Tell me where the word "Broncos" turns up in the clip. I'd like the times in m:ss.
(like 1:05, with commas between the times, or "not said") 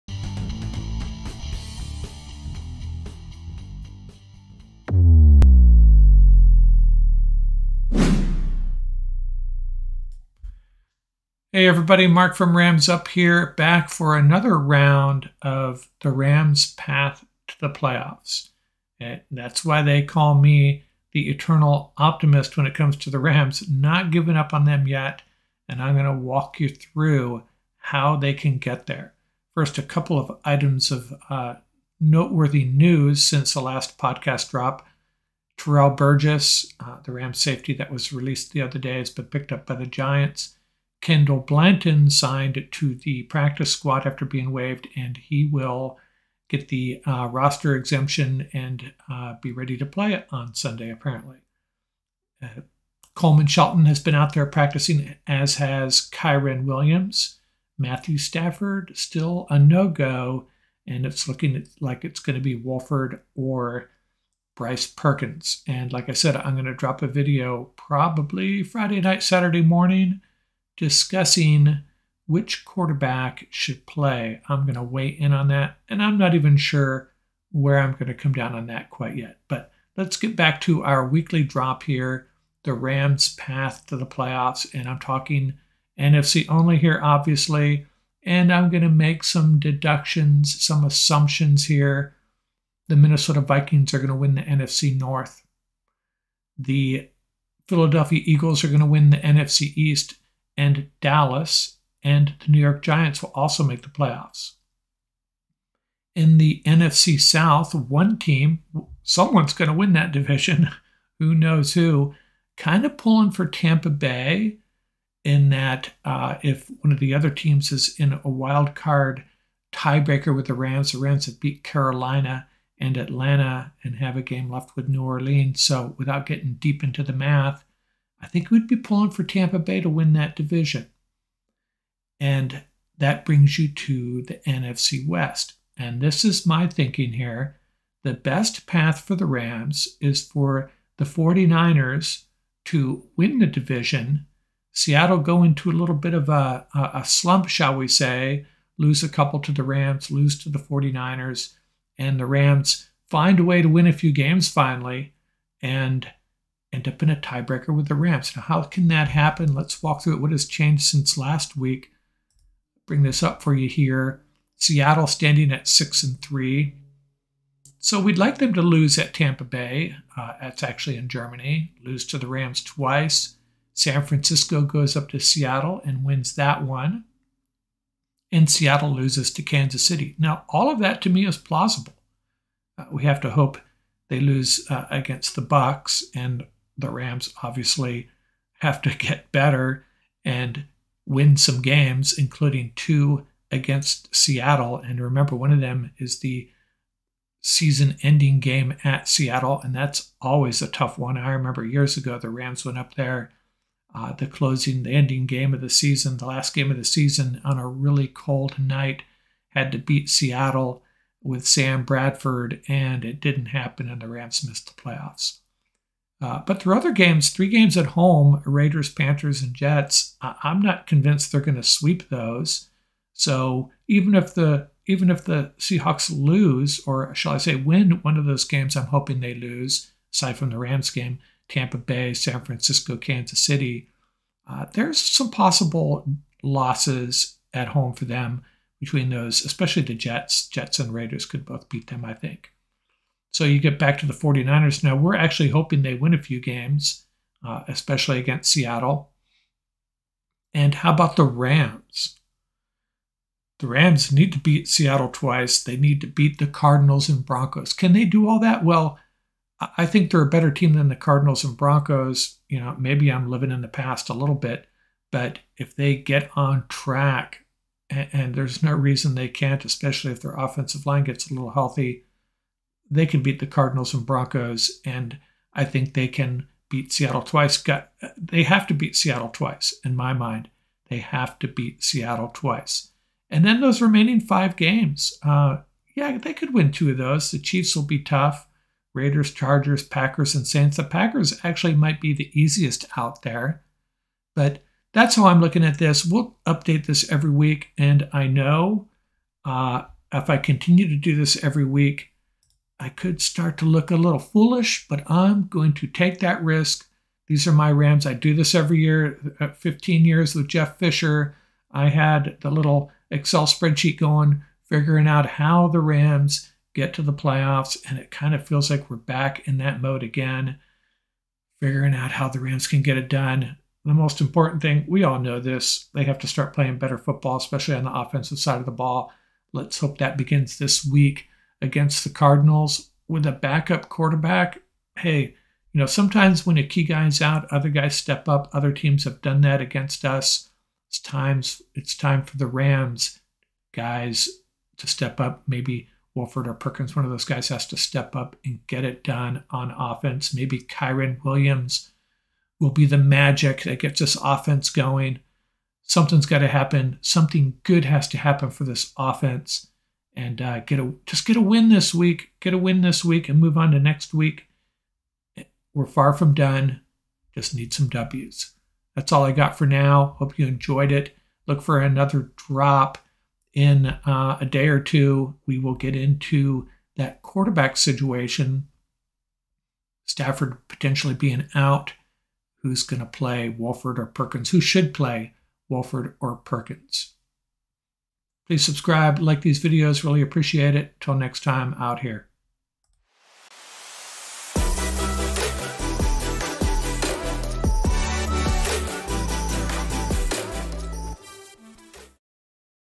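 4:17, 4:21, 4:34.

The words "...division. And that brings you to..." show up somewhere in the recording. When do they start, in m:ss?
2:10.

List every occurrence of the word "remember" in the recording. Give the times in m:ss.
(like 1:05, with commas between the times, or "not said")
3:14, 3:21.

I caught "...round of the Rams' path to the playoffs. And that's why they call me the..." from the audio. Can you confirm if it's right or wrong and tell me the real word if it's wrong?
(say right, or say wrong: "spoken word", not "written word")
right.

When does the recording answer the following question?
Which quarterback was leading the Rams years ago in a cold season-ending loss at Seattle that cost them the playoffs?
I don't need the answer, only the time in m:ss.
3:31.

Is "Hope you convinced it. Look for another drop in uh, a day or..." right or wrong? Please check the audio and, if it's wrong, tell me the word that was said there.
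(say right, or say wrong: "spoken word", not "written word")
wrong: "enjoyed", not "convinced".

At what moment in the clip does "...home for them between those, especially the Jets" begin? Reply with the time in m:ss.
3:57.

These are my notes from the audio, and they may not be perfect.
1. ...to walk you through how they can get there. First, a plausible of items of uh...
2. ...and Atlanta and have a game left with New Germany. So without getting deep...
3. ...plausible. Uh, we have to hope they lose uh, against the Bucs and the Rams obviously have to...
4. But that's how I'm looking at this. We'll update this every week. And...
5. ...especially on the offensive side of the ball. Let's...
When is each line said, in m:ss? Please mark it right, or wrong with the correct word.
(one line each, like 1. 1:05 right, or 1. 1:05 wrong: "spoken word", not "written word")
1. 0:26 wrong: "couple", not "plausible"
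2. 2:02 wrong: "Orleans", not "Germany"
3. 3:01 right
4. 4:54 right
5. 5:27 right.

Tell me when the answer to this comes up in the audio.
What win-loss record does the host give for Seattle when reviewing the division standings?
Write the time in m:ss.
2:45.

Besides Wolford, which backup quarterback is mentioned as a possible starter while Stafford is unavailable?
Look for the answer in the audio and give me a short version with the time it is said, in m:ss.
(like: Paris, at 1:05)
Bryce Perkins, at 1:04.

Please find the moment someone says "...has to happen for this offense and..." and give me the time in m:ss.
5:57.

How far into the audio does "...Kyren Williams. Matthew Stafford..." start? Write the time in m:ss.
0:56.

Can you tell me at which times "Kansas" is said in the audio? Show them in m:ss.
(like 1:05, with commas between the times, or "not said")
2:59, 3:52.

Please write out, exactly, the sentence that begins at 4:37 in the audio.
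Got, they have to beat Seattle twice, in my mind.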